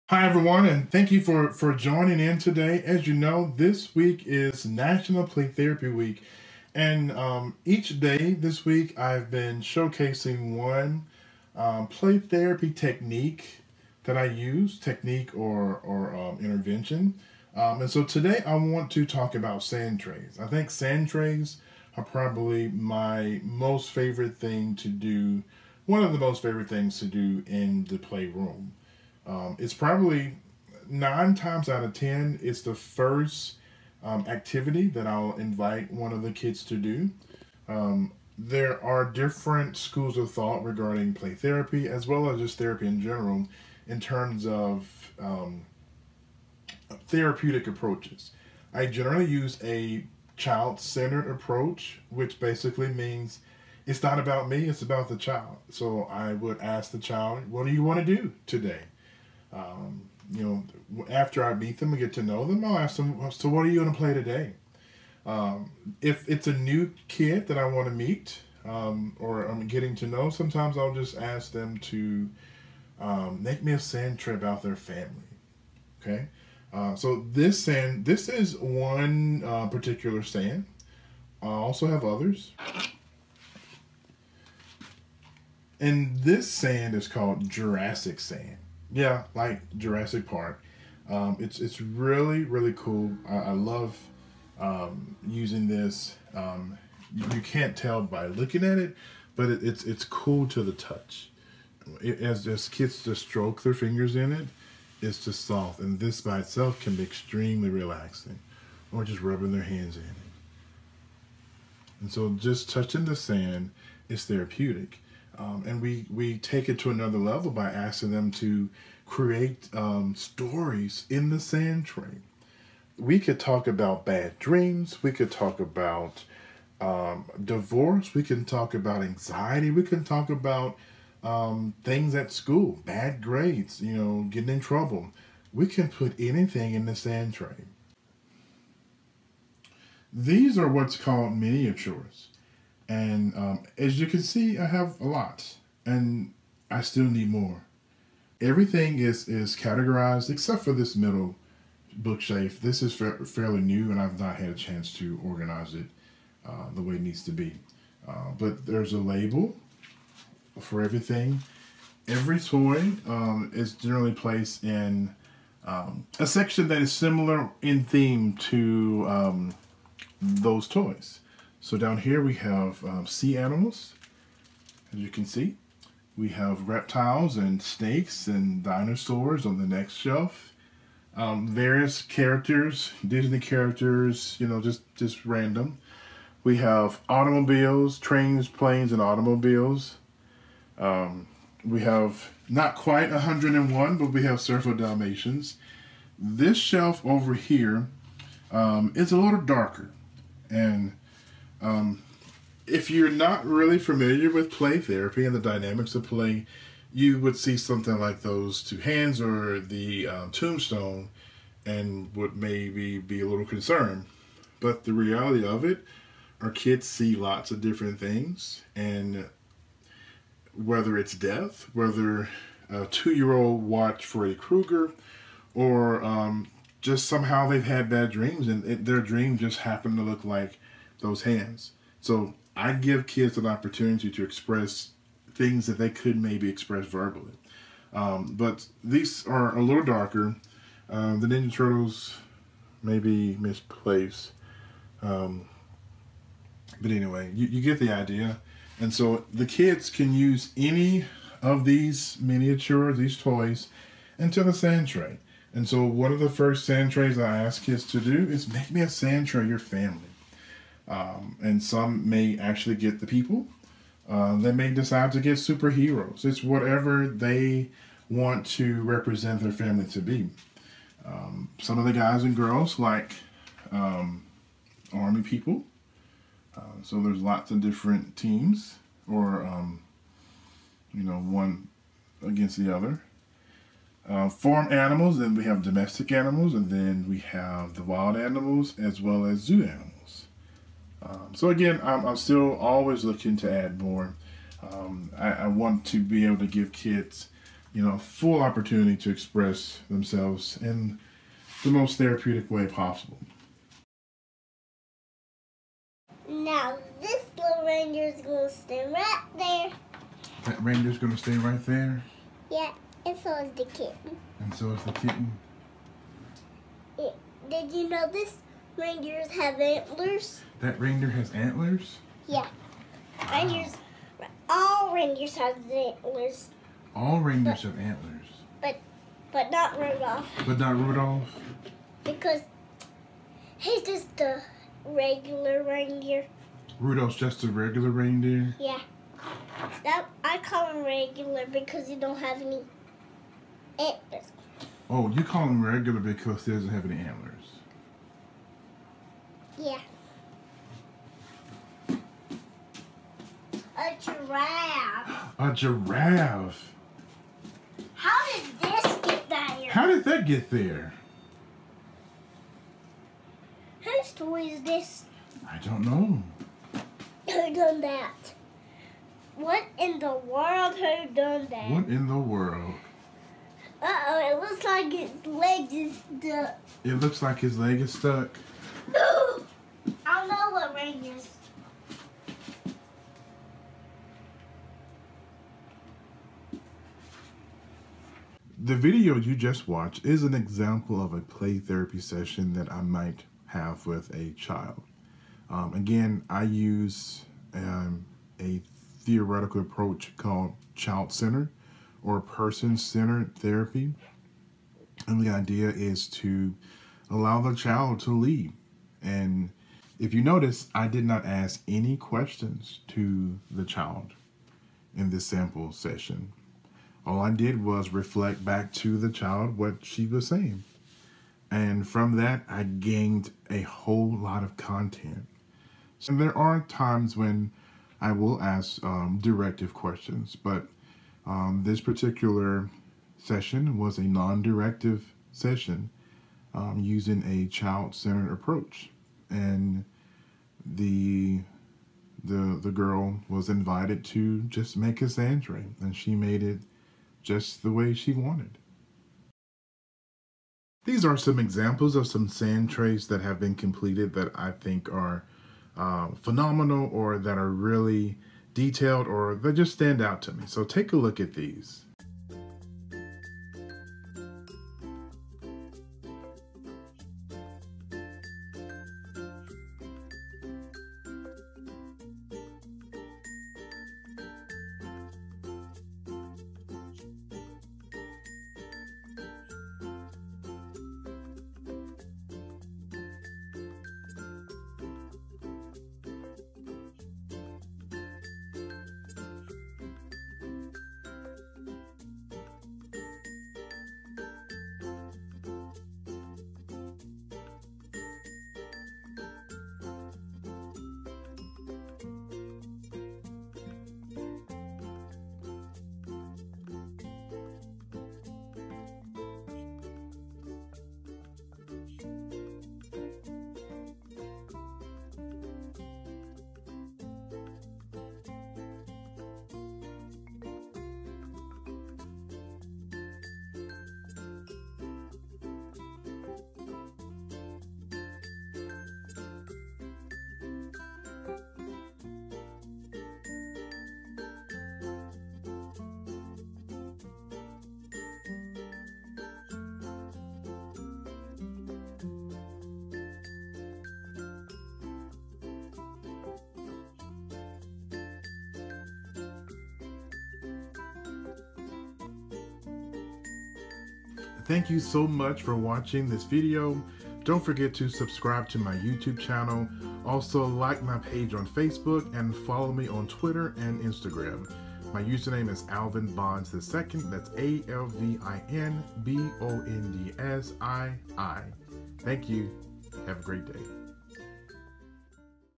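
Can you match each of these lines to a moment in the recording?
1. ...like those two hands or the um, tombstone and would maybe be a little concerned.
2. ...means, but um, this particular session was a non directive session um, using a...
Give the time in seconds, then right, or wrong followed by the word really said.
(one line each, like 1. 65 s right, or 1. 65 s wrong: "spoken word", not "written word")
1. 207 s right
2. 429 s wrong: "questions", not "means".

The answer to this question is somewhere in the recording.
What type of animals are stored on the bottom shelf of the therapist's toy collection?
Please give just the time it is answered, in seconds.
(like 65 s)
173 s.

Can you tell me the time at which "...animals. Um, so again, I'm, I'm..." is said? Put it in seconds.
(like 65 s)
289 s.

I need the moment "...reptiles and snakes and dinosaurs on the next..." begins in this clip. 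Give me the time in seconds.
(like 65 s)
176 s.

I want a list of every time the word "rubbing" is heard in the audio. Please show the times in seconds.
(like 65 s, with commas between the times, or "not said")
109 s.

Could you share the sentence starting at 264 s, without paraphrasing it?
Uh, they may decide to get superheroes.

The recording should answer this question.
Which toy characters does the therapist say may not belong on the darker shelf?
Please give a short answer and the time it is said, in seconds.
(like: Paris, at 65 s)
Ninja Turtles, at 241 s.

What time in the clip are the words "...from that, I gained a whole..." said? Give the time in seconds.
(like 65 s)
421 s.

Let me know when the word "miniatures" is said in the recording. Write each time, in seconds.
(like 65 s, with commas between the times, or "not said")
141 s, 252 s.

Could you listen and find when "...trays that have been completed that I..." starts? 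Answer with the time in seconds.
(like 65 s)
452 s.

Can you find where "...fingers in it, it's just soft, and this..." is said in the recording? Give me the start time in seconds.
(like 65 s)
103 s.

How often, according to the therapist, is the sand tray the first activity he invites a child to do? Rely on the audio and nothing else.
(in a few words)
nine times out of ten.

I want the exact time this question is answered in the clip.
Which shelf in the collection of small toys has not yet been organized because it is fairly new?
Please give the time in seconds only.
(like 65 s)
150 s.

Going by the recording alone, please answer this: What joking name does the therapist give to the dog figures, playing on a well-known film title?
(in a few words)
Surfer Dalmatians.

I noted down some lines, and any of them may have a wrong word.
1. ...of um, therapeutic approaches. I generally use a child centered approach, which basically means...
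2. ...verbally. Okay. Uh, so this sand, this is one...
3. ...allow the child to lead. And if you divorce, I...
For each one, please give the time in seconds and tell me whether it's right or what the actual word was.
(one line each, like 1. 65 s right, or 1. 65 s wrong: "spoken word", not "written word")
1. 44 s right
2. 74 s wrong: "family", not "verbally"
3. 407 s wrong: "notice", not "divorce".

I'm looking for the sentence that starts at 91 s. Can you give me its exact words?
Um, it's it's really really cool.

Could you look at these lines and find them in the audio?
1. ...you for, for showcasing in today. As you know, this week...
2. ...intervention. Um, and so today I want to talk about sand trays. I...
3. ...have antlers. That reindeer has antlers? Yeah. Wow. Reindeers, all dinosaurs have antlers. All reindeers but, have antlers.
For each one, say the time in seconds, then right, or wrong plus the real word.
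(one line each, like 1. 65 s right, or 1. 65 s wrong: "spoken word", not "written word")
1. 1 s wrong: "joining", not "showcasing"
2. 16 s right
3. 319 s wrong: "reindeers", not "dinosaurs".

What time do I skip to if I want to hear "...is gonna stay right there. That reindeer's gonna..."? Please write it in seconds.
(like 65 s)
307 s.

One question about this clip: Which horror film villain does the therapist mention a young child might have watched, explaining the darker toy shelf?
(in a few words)
Freddy Krueger.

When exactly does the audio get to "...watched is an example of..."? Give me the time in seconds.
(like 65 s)
389 s.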